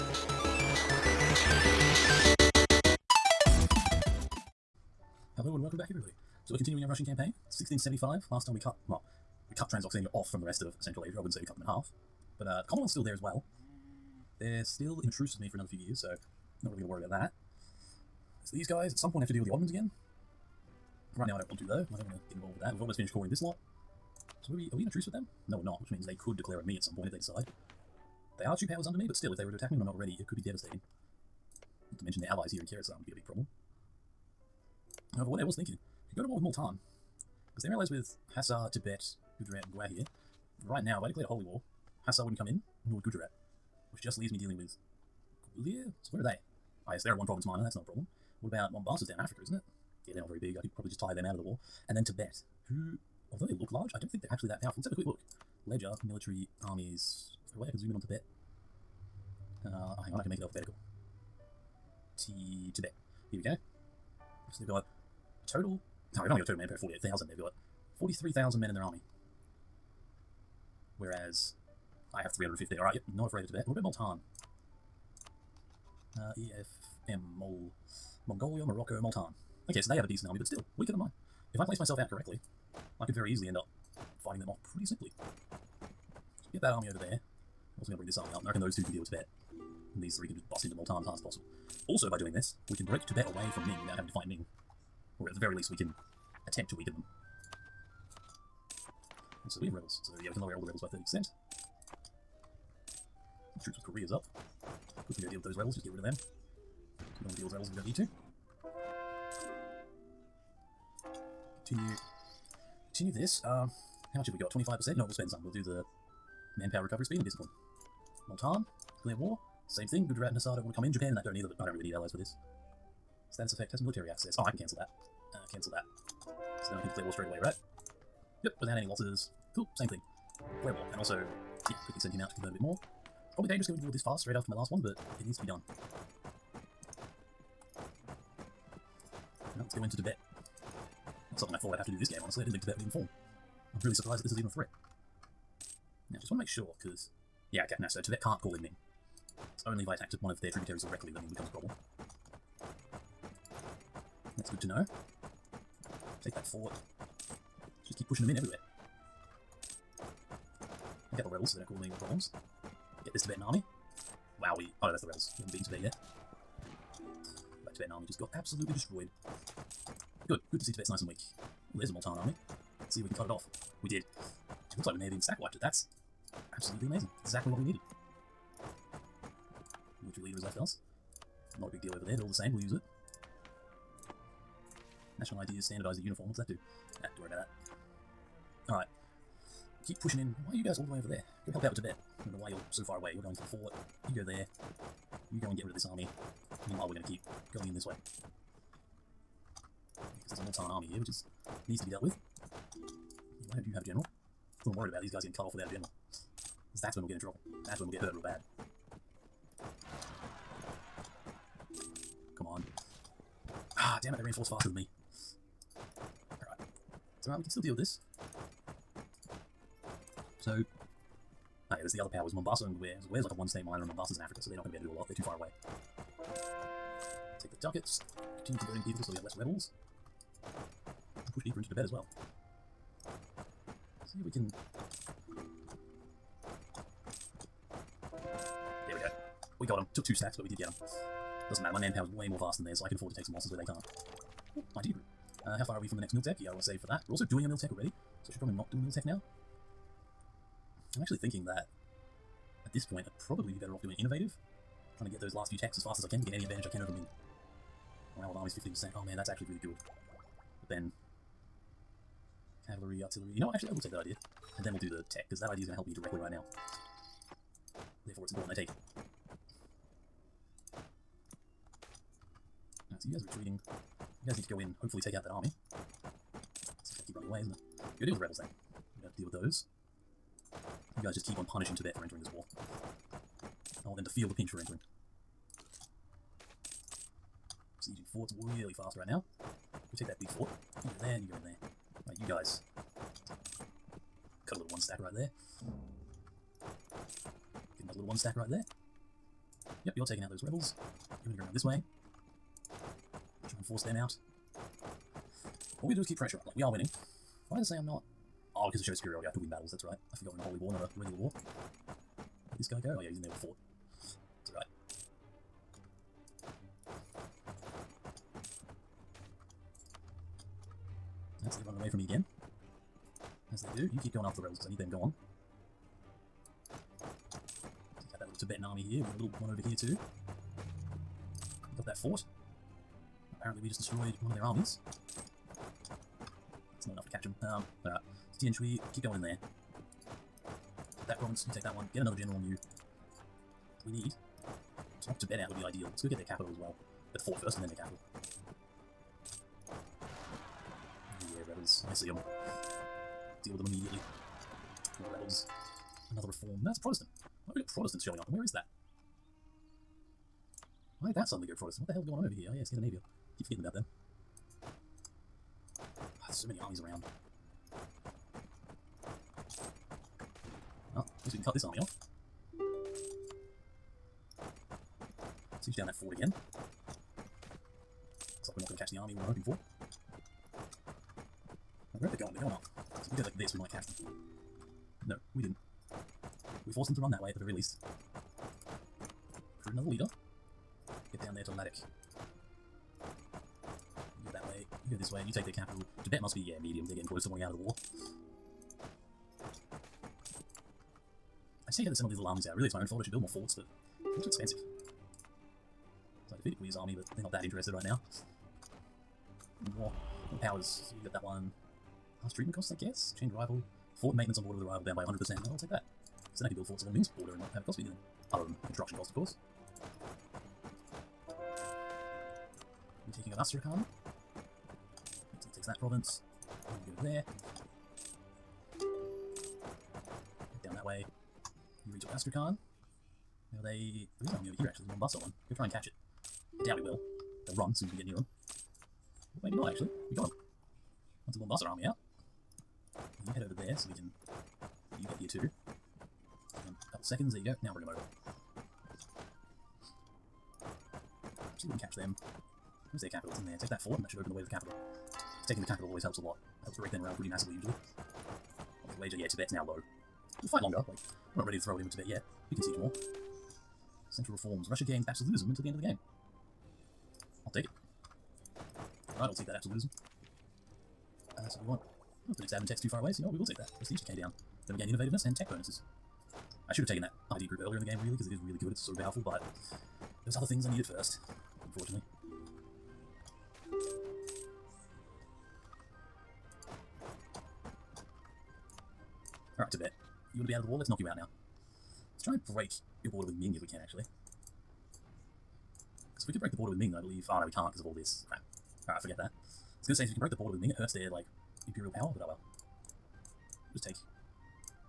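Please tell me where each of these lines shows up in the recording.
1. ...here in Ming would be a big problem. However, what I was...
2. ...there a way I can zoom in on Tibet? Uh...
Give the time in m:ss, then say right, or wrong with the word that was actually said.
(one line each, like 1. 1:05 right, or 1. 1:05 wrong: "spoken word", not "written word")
1. 0:32 wrong: "Khorasan", not "Ming"
2. 0:57 right.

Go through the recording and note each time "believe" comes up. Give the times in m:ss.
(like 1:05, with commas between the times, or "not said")
8:16.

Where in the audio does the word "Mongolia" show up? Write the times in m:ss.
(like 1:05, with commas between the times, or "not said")
1:18.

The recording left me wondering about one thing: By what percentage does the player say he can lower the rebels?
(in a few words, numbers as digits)
30%.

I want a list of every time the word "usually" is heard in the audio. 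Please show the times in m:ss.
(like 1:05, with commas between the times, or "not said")
7:37.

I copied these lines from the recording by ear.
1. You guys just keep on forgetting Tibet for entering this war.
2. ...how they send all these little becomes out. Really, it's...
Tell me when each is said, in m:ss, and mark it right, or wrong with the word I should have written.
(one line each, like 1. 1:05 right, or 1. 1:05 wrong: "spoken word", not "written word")
1. 4:41 wrong: "punishing", not "forgetting"
2. 6:41 wrong: "armies", not "becomes".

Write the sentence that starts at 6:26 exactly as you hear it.
We forced them to run that way at the very least.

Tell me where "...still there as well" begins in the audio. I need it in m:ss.
0:12.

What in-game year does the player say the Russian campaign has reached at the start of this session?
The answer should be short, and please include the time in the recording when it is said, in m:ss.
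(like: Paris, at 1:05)
1675, at 0:07.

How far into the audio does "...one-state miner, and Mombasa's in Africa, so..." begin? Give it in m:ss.
3:43.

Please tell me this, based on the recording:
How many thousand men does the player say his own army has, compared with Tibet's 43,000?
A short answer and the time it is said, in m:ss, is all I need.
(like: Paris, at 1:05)
315, at 1:12.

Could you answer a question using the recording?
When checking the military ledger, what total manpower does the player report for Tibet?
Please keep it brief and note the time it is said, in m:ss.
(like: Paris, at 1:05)
48,000, at 1:06.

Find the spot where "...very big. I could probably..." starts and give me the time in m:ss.
0:50.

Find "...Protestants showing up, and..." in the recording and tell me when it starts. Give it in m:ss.
5:57.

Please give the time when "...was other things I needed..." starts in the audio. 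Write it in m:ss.
8:00.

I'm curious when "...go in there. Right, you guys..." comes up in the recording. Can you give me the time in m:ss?
4:51.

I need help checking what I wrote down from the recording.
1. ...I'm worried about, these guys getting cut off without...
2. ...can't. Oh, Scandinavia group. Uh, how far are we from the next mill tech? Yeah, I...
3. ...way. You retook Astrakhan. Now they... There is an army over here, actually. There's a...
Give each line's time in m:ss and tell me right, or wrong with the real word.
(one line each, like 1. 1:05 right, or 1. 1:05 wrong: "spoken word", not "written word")
1. 3:24 right
2. 4:03 wrong: "Idea", not "Scandinavia"
3. 7:10 right.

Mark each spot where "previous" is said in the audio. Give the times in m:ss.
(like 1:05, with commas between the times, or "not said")
not said.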